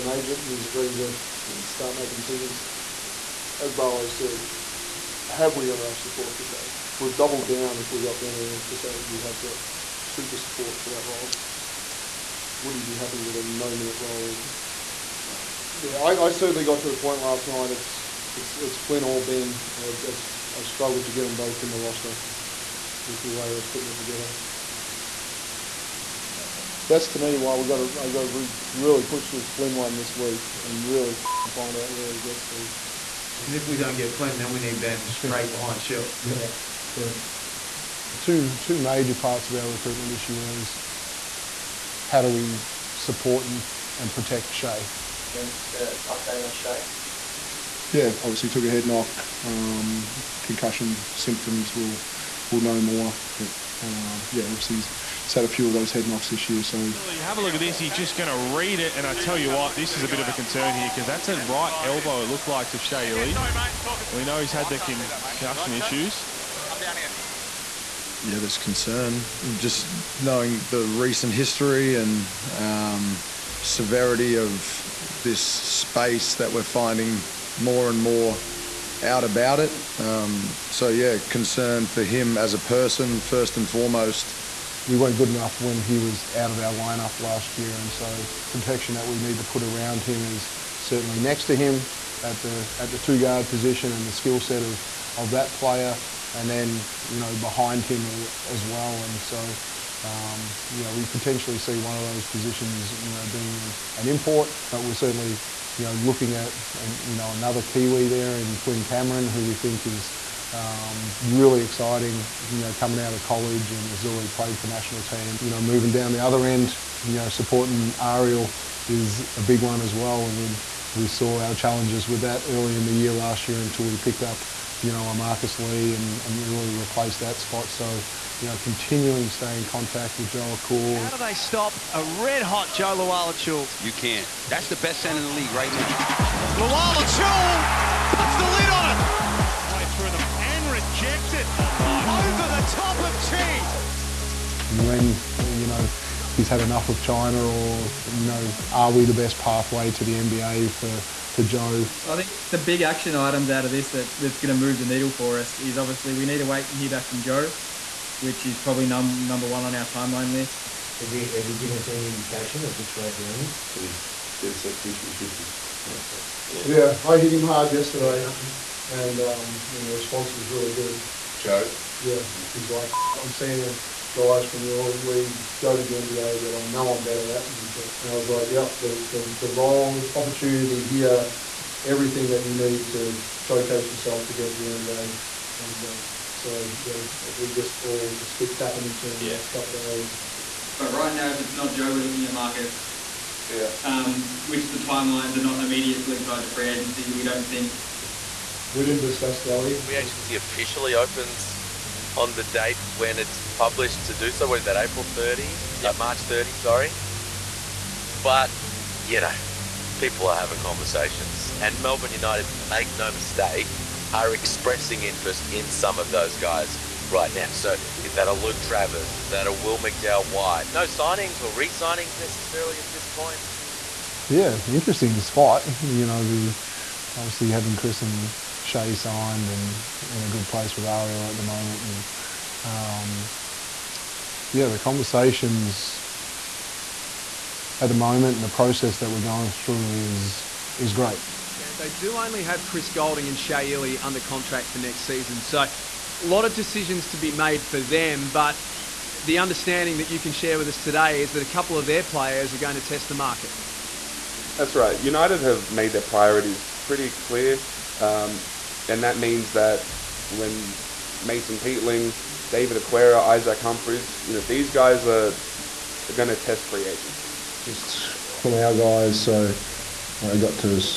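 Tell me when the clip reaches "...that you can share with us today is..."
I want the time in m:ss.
4:09.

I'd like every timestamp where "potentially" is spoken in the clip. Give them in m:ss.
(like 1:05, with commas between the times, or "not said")
1:41.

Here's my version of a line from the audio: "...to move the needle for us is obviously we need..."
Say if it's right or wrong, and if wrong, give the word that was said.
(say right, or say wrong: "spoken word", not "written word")
right.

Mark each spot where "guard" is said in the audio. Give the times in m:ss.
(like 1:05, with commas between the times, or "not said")
1:33.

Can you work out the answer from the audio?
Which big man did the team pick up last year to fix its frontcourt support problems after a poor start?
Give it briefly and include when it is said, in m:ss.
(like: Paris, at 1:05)
Marcus Lee, at 2:05.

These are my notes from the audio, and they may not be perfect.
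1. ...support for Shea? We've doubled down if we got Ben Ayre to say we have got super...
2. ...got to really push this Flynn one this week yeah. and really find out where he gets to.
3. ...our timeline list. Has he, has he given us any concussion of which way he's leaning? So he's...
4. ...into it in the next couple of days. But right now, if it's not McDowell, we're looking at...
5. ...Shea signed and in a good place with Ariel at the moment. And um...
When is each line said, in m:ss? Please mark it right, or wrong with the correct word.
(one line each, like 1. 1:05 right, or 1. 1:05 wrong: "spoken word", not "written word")
1. 0:05 right
2. 0:28 right
3. 2:39 wrong: "indication", not "concussion"
4. 3:08 wrong: "Joe", not "McDowell"
5. 3:48 right.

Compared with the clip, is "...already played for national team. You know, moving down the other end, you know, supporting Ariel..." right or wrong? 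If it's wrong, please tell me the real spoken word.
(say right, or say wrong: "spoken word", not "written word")
right.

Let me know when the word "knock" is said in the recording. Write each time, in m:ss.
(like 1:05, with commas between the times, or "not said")
0:48, 0:56.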